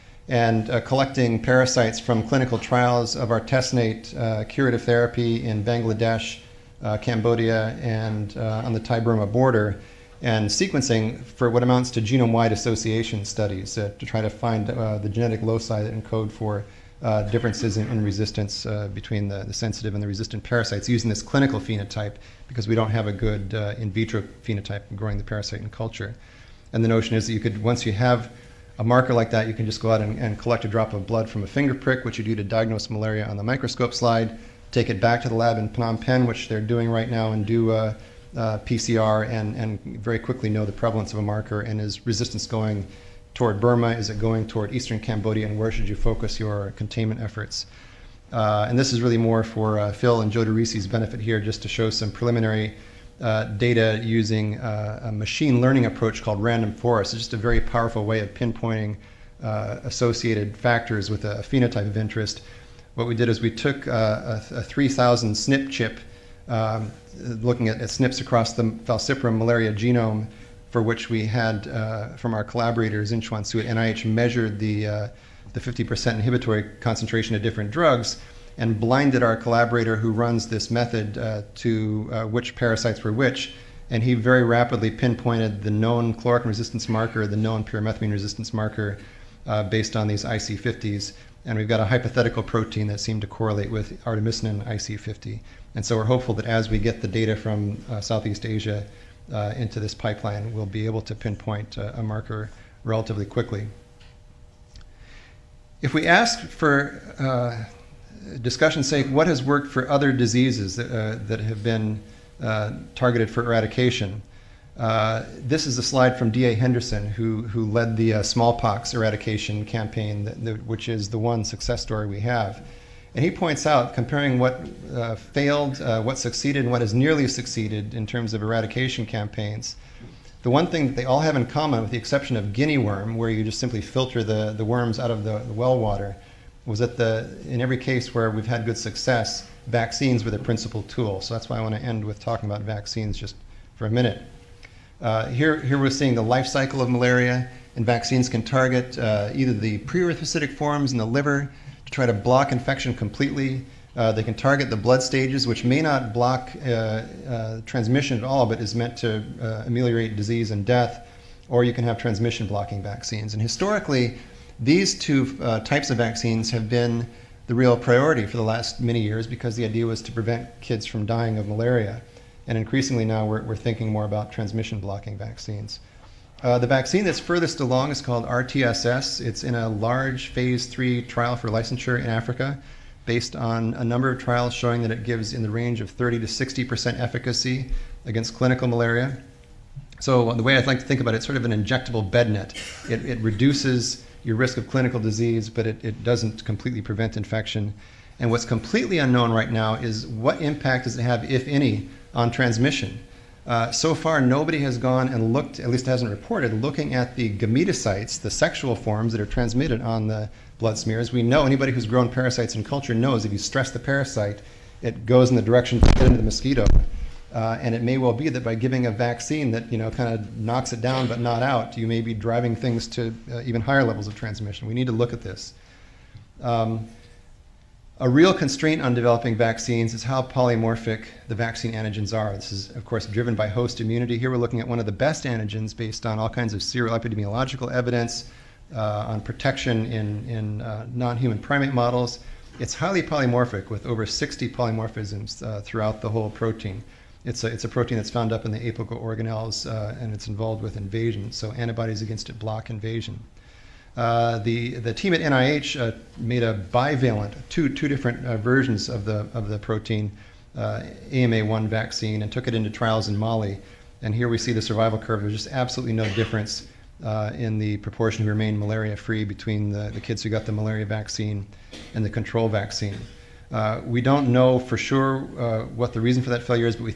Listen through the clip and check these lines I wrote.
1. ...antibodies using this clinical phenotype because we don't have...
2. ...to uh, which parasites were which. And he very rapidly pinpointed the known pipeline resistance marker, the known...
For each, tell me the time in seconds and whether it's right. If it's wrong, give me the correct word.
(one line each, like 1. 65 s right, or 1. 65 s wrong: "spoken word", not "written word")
1. 20 s wrong: "parasites", not "antibodies"
2. 81 s wrong: "chloroquine", not "pipeline".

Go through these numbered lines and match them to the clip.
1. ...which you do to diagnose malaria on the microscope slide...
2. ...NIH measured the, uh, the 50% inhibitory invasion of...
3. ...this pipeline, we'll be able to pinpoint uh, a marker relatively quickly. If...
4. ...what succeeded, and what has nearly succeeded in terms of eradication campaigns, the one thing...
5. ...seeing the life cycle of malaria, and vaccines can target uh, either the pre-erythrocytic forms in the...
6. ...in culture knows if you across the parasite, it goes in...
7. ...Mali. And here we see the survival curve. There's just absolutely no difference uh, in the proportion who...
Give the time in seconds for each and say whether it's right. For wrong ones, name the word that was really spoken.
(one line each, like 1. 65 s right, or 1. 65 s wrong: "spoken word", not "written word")
1. 32 s right
2. 73 s wrong: "concentration", not "invasion"
3. 99 s right
4. 126 s right
5. 145 s right
6. 212 s wrong: "stress", not "across"
7. 263 s right.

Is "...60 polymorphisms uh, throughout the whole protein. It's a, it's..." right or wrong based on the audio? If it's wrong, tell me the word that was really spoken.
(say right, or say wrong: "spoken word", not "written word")
right.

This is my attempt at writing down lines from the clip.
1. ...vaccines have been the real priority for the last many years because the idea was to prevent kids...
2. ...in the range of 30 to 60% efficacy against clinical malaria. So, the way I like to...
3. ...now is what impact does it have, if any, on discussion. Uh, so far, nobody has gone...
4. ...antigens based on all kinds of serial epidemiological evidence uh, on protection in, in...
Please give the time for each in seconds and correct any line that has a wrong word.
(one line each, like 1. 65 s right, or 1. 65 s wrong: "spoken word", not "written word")
1. 165 s right
2. 185 s right
3. 199 s wrong: "transmission", not "discussion"
4. 235 s right.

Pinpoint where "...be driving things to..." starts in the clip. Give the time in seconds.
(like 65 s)
222 s.